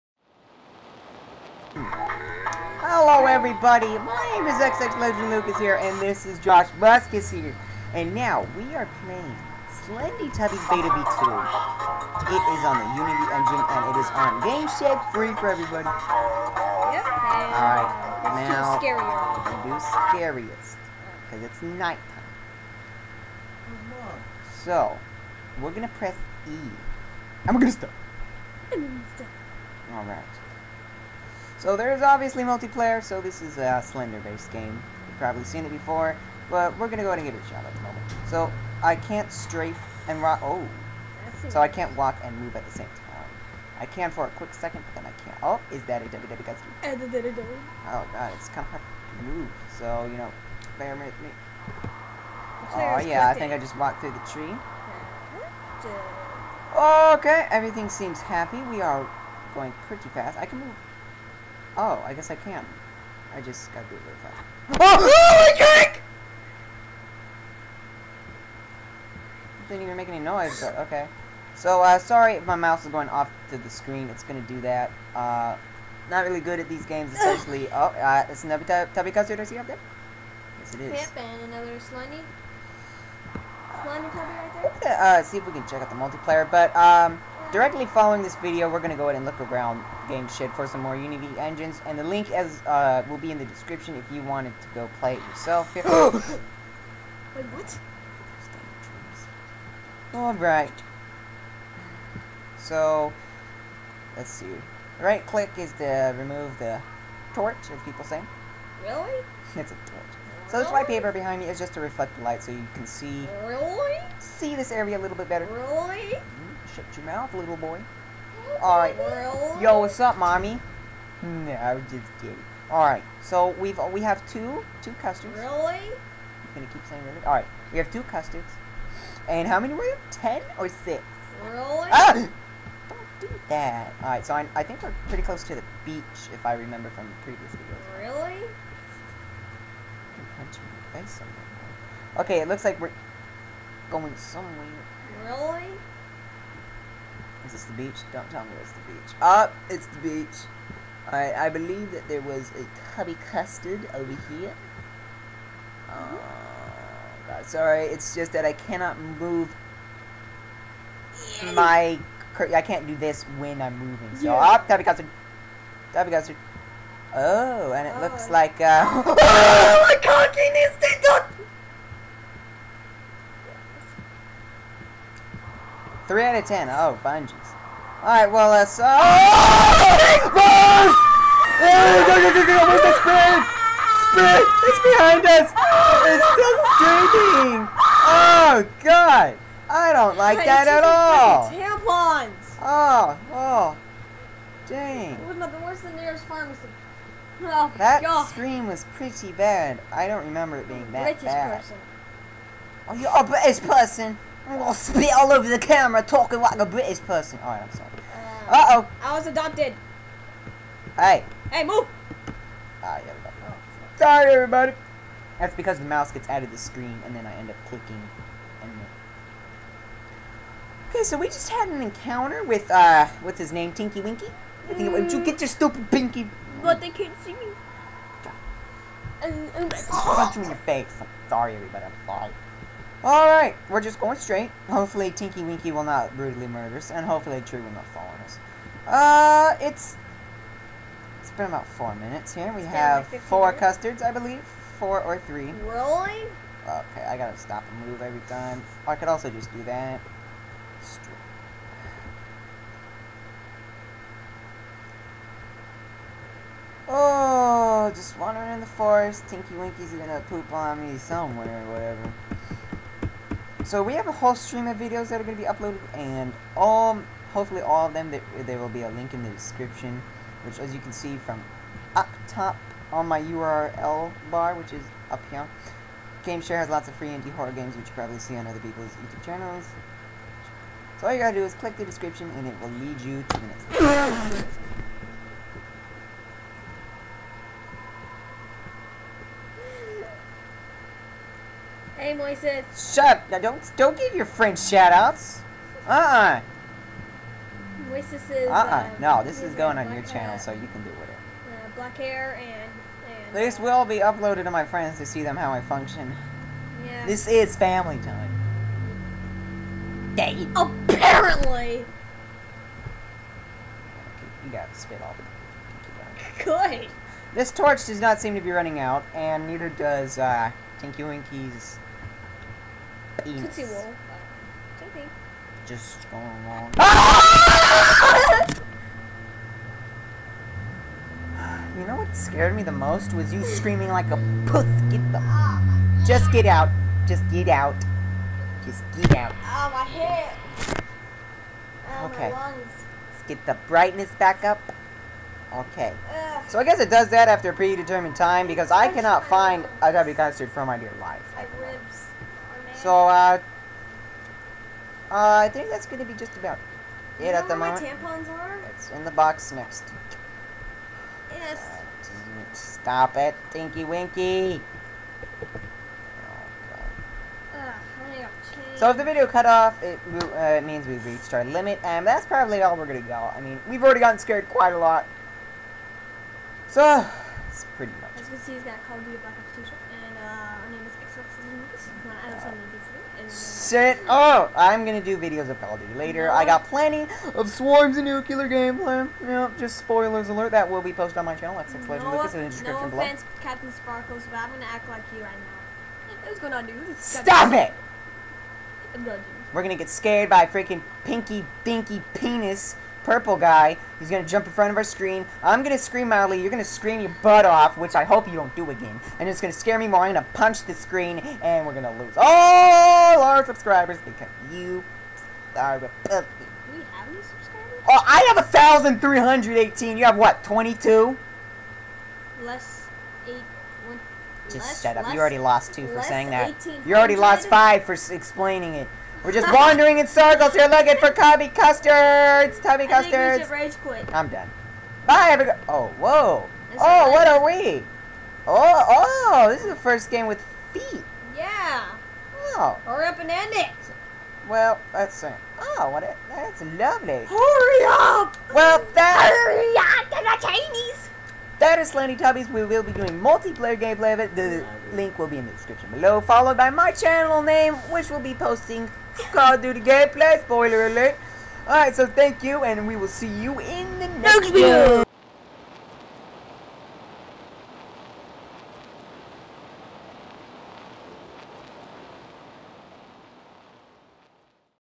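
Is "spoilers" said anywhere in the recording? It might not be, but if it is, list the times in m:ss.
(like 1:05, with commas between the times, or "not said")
6:29, 7:40.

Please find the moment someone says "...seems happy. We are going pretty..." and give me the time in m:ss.
0:57.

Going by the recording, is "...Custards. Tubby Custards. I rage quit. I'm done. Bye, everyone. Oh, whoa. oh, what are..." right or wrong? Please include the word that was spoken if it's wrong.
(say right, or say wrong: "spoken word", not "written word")
right.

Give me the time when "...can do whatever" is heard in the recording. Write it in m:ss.
5:00.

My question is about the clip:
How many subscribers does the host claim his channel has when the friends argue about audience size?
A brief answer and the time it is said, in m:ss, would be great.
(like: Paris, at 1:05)
1,318, at 6:58.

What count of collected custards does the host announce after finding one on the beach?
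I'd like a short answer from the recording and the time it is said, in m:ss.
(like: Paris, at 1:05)
Three out of ten, at 2:56.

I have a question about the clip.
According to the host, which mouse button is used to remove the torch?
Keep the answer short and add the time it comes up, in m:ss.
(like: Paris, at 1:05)
Right click, at 1:45.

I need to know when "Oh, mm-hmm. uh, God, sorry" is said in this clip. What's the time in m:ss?
2:35.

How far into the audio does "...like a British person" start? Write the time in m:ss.
3:26.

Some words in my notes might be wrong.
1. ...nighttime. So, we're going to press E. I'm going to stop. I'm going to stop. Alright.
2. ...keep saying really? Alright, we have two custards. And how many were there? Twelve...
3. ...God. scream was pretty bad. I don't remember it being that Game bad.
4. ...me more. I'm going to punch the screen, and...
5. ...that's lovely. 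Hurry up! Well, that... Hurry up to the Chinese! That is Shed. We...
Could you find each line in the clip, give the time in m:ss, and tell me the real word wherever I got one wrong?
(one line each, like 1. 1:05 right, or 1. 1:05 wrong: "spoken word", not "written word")
1. 0:21 right
2. 2:06 wrong: "Ten", not "Twelve"
3. 3:18 wrong: "British", not "Game"
4. 6:49 right
5. 7:26 wrong: "Slendytubbies", not "Shed".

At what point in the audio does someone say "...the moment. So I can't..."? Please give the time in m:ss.
0:37.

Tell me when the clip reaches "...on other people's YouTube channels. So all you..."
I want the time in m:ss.
4:38.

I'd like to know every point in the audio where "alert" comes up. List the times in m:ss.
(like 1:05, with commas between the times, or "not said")
6:30, 7:40.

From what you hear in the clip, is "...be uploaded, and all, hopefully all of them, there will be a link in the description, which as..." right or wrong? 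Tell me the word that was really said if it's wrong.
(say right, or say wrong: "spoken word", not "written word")
right.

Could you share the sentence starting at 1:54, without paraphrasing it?
see this area a little bit better.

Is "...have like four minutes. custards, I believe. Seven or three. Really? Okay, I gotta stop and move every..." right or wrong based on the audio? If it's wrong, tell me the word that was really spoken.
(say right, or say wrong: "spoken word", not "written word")
wrong: "Four", not "Seven".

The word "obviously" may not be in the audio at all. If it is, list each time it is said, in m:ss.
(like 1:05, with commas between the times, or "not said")
0:32.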